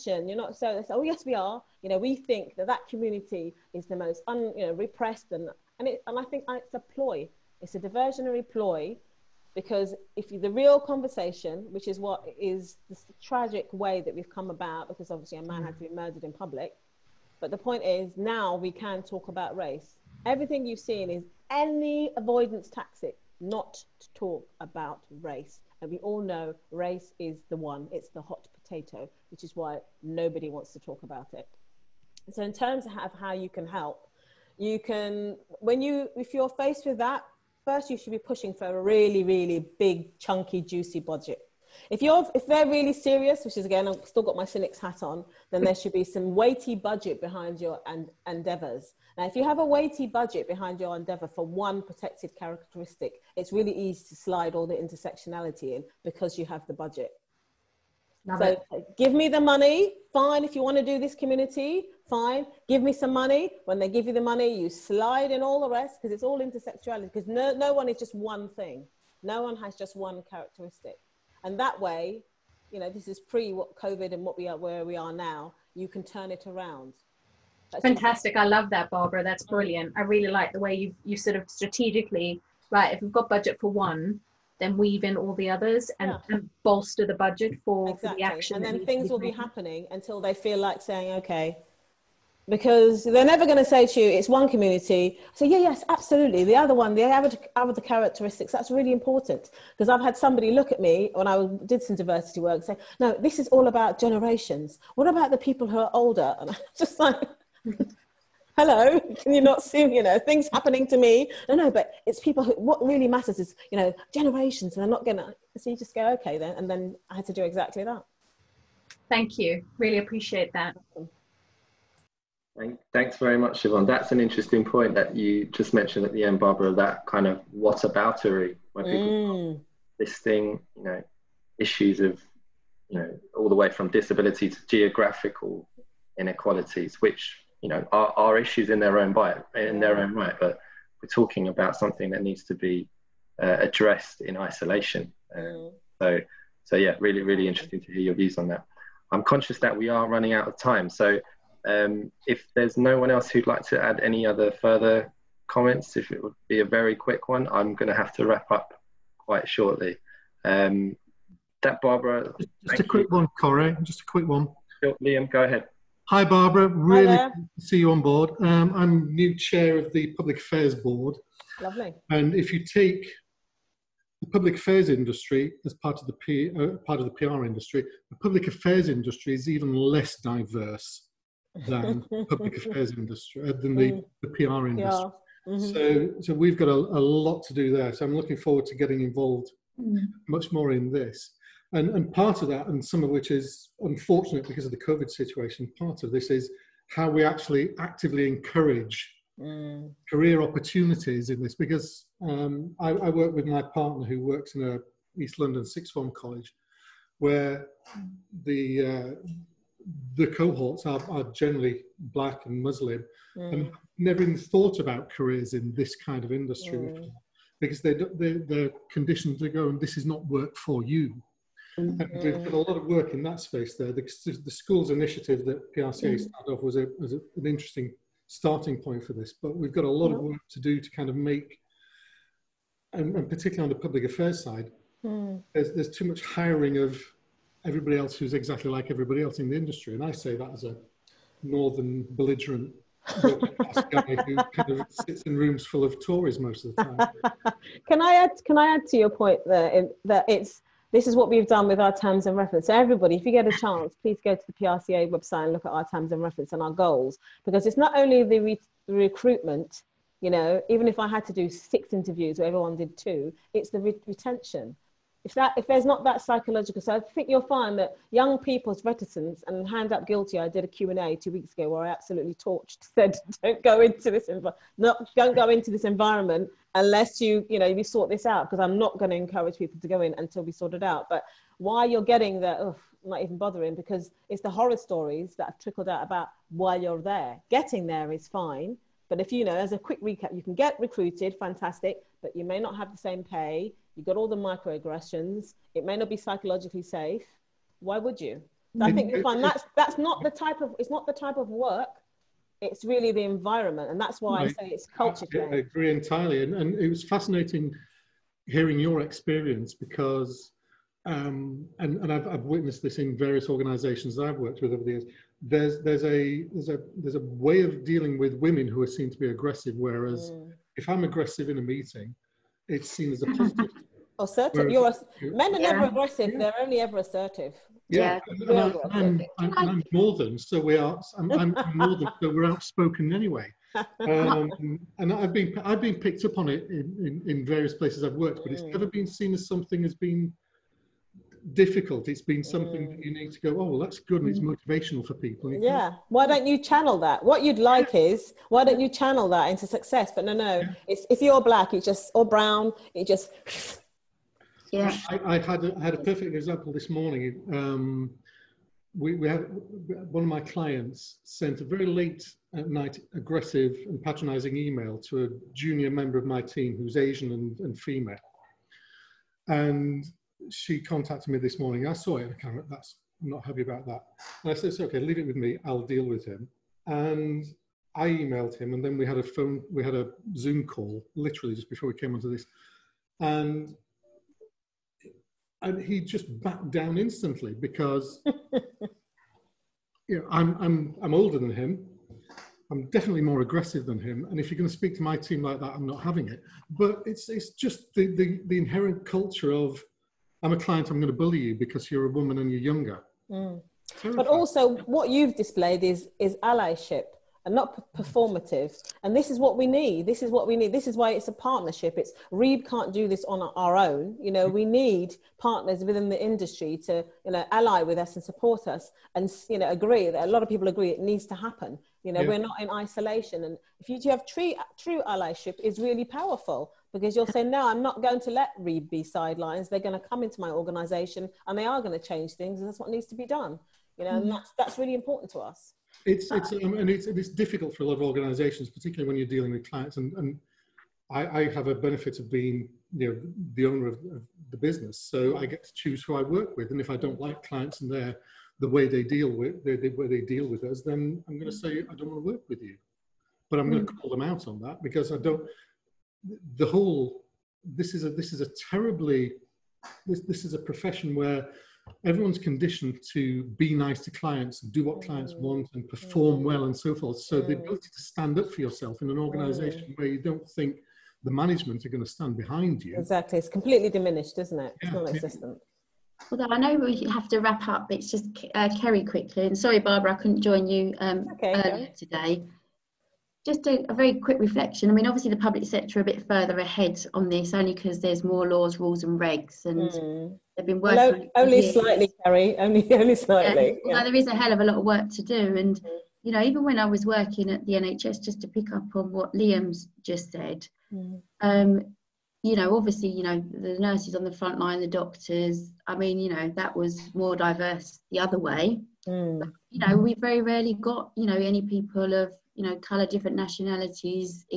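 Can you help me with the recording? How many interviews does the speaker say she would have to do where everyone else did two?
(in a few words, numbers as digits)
6.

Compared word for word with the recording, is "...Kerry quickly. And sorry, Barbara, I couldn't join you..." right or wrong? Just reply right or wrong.
right.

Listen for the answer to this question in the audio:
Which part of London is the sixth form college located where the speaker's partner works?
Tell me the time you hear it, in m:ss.
3:25.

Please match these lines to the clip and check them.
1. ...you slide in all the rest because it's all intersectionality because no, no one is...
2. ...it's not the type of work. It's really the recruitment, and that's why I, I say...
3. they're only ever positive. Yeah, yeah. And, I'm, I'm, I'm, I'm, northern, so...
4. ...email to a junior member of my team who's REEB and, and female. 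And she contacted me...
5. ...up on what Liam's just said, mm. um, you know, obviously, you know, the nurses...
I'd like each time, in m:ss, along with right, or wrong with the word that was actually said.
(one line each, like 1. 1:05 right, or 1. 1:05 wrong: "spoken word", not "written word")
1. 1:04 right
2. 5:00 wrong: "environment", not "recruitment"
3. 5:26 wrong: "assertive", not "positive"
4. 6:04 wrong: "Asian", not "REEB"
5. 8:18 right.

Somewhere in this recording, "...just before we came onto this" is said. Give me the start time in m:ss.
6:21.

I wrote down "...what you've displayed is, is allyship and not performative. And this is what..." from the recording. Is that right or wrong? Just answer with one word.
right.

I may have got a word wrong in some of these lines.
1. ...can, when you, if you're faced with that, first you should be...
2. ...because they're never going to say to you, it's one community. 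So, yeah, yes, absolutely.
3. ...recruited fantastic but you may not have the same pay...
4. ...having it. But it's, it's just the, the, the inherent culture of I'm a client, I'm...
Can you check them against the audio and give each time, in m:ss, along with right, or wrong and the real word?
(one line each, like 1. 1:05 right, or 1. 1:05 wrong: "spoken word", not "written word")
1. 0:34 right
2. 1:32 right
3. 4:50 right
4. 6:36 right.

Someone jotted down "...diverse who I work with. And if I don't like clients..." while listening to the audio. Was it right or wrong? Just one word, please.
wrong.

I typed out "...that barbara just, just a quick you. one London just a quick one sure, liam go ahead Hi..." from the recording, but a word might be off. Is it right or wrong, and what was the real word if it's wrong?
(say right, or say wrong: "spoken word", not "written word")
wrong: "Koray", not "London".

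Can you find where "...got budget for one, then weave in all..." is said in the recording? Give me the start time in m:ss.
1:23.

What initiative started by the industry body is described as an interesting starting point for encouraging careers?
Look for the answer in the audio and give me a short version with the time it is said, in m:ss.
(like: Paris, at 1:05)
The schools initiative, at 3:44.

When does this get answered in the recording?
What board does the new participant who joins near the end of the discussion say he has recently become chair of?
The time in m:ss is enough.
2:50.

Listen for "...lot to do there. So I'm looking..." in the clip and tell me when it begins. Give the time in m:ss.
3:07.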